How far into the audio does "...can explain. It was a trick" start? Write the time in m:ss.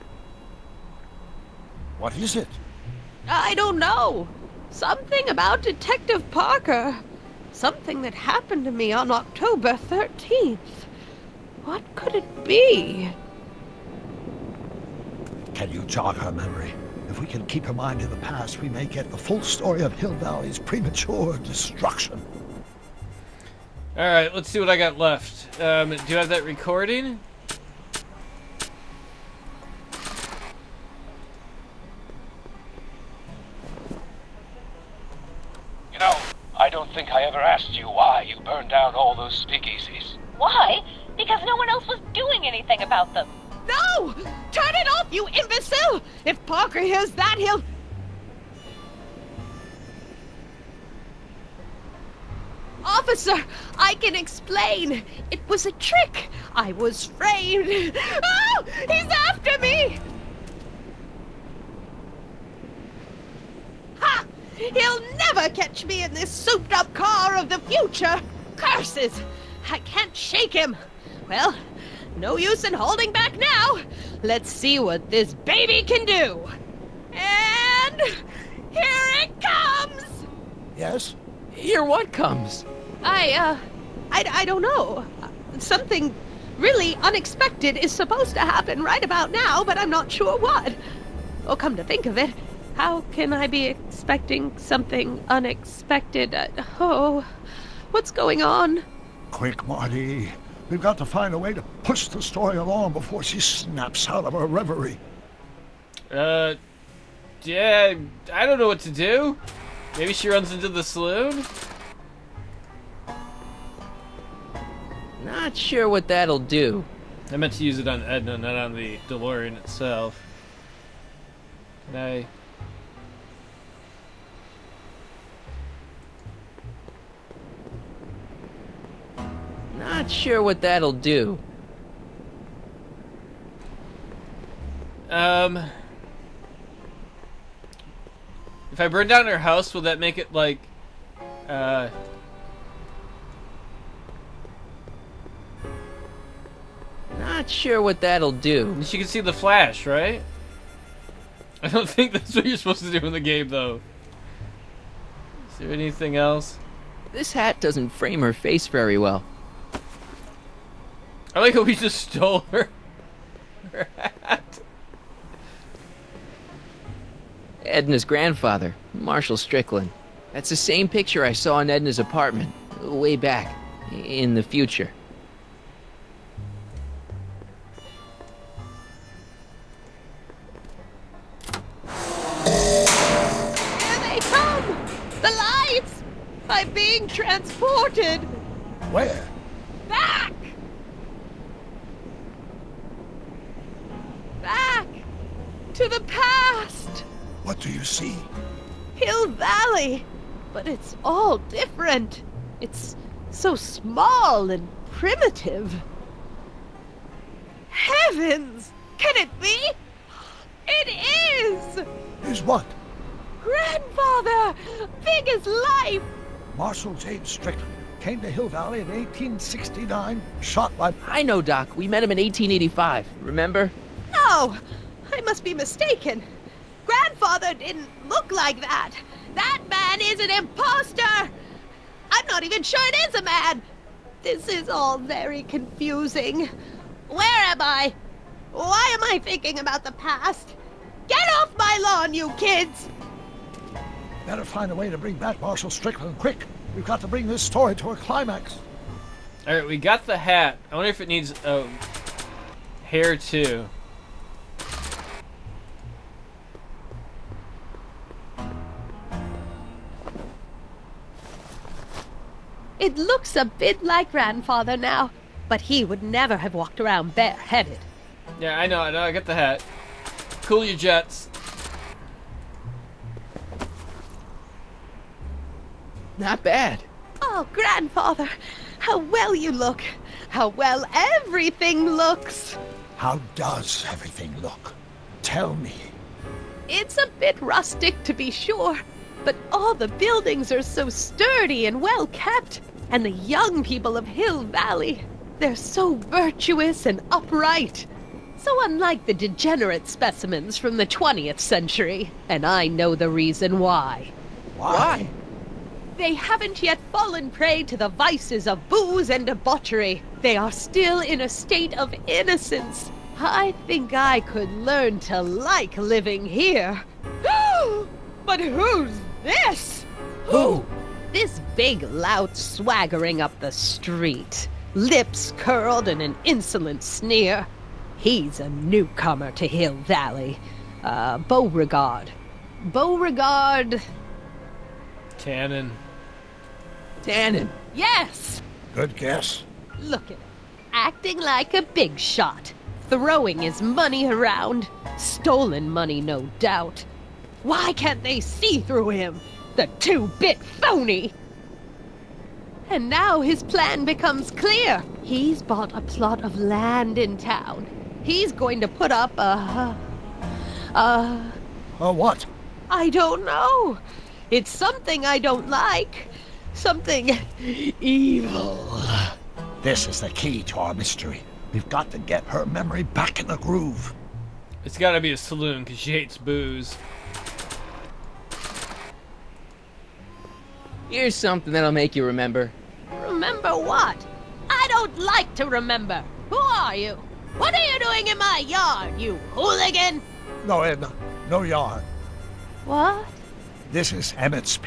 0:53.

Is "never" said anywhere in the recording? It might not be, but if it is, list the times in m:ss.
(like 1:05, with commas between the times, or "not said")
1:05, 4:26.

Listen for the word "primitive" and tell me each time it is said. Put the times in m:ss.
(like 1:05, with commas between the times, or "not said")
3:24.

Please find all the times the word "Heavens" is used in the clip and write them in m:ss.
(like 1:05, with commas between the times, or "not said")
3:27.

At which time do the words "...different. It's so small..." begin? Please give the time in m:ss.
3:21.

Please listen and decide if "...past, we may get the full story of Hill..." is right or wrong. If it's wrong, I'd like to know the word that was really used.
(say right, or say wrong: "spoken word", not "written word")
right.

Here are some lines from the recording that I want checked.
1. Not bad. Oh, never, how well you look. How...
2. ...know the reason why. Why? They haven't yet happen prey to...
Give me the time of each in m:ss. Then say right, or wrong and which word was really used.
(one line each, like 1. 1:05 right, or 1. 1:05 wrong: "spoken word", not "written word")
1. 4:36 wrong: "grandfather", not "never"
2. 5:02 wrong: "fallen", not "happen".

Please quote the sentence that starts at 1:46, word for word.
Uh, yeah, I don't know what to do.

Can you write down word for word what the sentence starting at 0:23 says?
Alright, let's see what I got left.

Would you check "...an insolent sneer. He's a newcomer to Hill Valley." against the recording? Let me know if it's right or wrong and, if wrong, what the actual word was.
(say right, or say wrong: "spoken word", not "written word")
right.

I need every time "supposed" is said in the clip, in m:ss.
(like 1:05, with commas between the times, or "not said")
1:27, 2:32.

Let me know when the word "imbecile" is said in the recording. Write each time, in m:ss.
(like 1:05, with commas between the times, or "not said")
0:45.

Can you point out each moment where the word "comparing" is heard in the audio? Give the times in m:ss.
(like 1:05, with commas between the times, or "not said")
not said.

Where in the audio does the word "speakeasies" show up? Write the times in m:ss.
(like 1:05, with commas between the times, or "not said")
0:39.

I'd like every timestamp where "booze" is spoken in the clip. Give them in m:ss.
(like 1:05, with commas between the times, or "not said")
5:08, 6:16.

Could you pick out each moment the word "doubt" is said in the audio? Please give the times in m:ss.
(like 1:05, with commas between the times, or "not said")
5:46.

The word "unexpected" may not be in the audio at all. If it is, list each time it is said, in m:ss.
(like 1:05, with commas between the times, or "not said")
1:26, 1:35.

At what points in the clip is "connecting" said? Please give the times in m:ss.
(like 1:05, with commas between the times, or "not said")
not said.